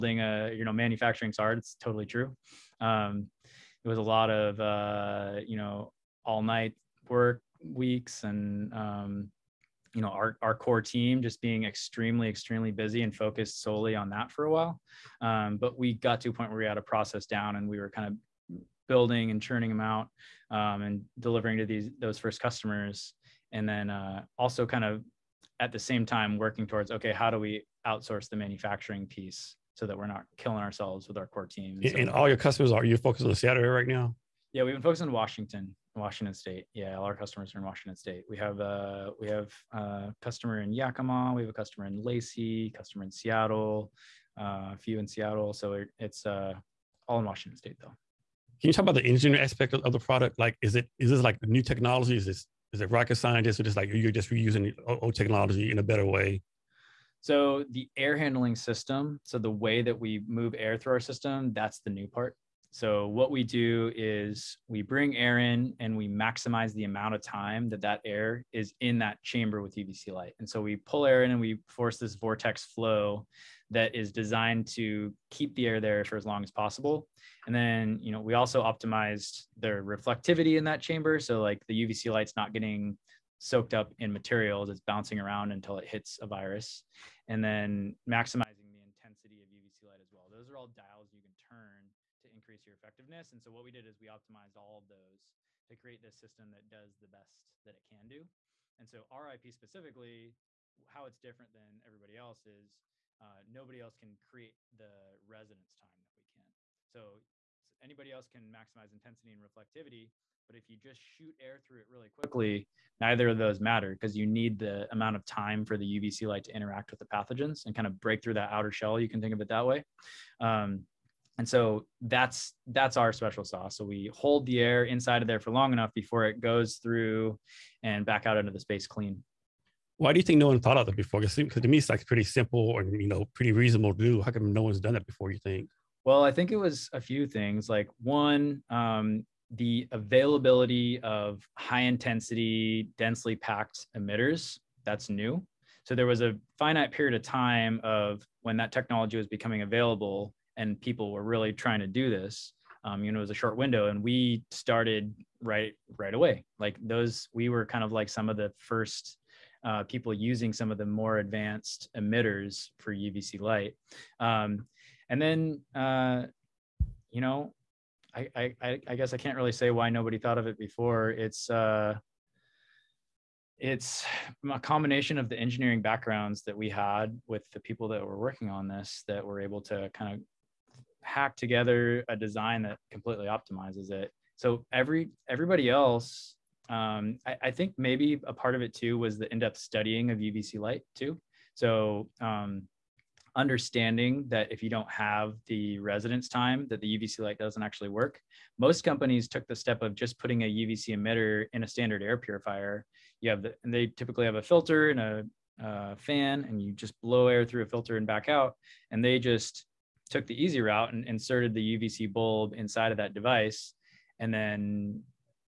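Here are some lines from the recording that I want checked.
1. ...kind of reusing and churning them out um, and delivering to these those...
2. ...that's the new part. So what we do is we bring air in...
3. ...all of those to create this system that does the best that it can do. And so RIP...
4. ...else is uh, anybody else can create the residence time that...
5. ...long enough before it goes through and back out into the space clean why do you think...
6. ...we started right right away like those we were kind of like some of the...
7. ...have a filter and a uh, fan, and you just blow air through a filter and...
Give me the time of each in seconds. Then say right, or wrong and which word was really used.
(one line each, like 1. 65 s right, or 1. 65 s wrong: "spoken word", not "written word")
1. 17 s wrong: "building", not "reusing"
2. 61 s right
3. 94 s right
4. 102 s wrong: "nobody", not "anybody"
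5. 125 s right
6. 154 s right
7. 204 s right.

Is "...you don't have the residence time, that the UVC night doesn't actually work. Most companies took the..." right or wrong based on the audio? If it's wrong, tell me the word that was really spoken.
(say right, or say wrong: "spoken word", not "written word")
wrong: "light", not "night".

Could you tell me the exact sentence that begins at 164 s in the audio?
Um, and then, uh, you know, I, I, I guess I can't really say why nobody thought of it before.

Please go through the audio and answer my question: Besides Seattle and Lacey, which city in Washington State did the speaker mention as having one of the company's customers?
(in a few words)
Yakima.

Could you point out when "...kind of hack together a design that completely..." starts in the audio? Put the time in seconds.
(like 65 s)
179 s.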